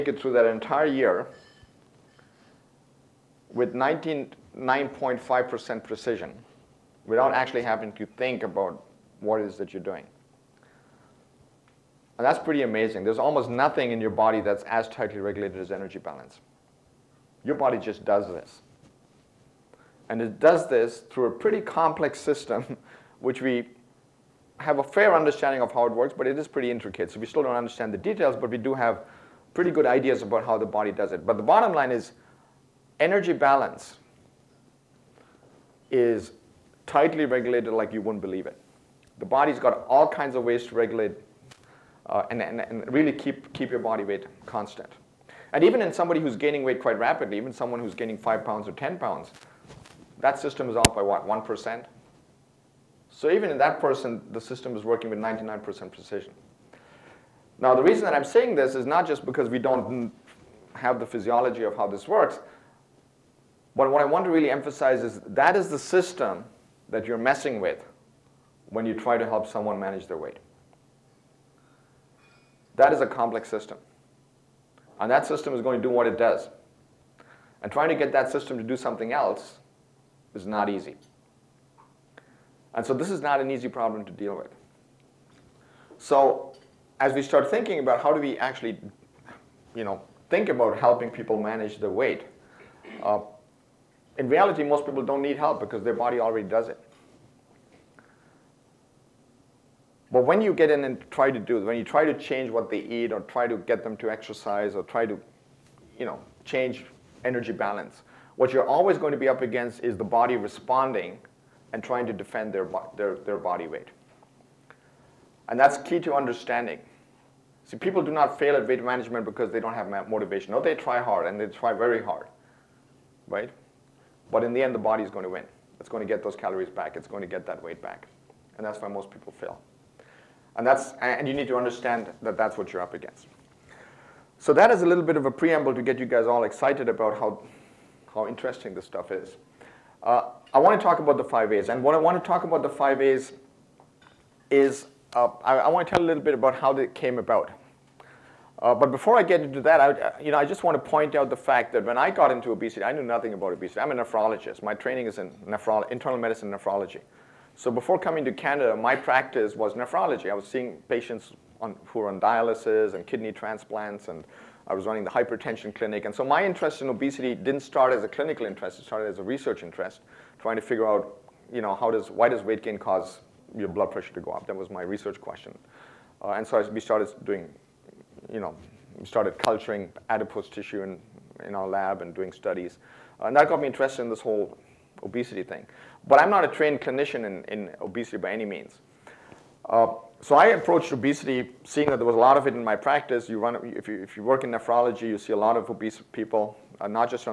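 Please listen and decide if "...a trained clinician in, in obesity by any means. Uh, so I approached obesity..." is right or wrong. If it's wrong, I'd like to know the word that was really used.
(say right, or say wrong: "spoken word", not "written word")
right.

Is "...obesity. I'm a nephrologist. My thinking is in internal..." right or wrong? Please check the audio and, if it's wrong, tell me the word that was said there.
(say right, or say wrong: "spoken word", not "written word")
wrong: "training", not "thinking".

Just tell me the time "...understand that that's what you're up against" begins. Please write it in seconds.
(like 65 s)
131 s.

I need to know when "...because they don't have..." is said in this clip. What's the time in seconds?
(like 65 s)
119 s.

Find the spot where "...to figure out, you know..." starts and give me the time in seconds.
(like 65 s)
170 s.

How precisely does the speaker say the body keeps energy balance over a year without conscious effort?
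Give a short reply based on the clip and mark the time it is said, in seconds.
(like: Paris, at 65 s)
99.5%, at 3 s.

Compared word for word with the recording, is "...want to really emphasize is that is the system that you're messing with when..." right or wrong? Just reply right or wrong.
right.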